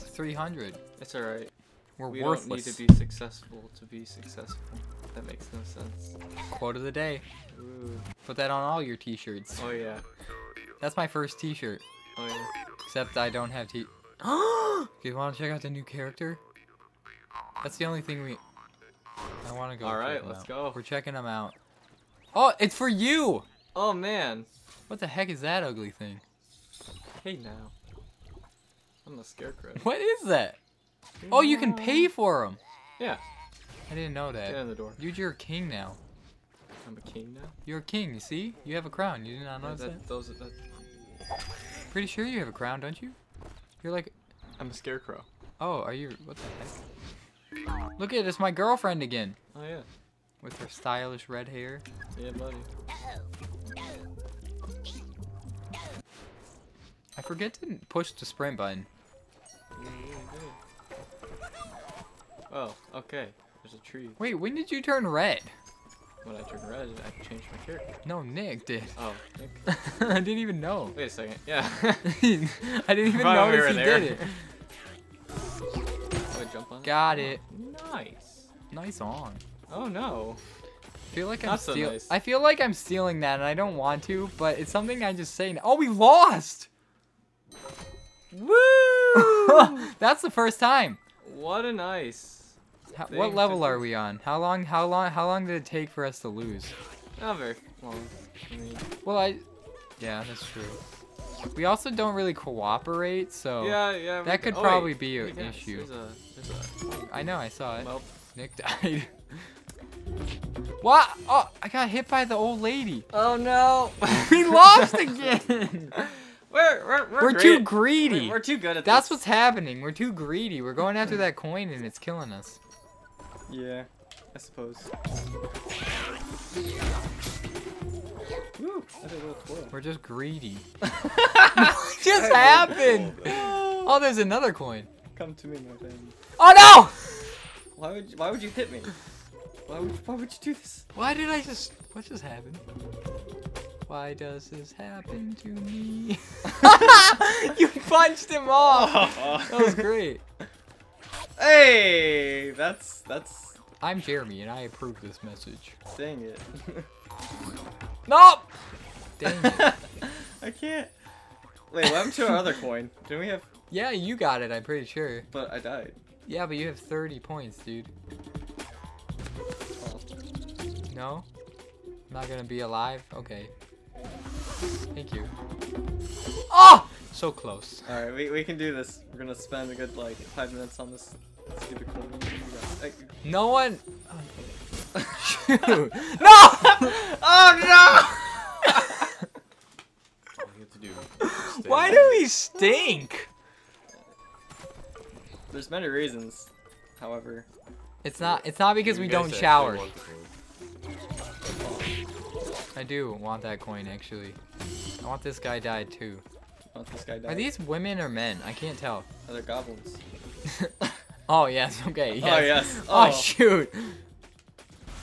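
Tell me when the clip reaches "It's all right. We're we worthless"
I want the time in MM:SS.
00:01.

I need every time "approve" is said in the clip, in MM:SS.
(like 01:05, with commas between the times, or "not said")
02:34.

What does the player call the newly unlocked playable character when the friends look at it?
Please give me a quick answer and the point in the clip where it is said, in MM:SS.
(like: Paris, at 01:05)
The scarecrow, at 00:29.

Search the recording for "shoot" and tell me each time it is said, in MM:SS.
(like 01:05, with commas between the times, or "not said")
03:05, 03:33.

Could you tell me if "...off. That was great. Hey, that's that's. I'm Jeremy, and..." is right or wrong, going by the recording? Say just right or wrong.
right.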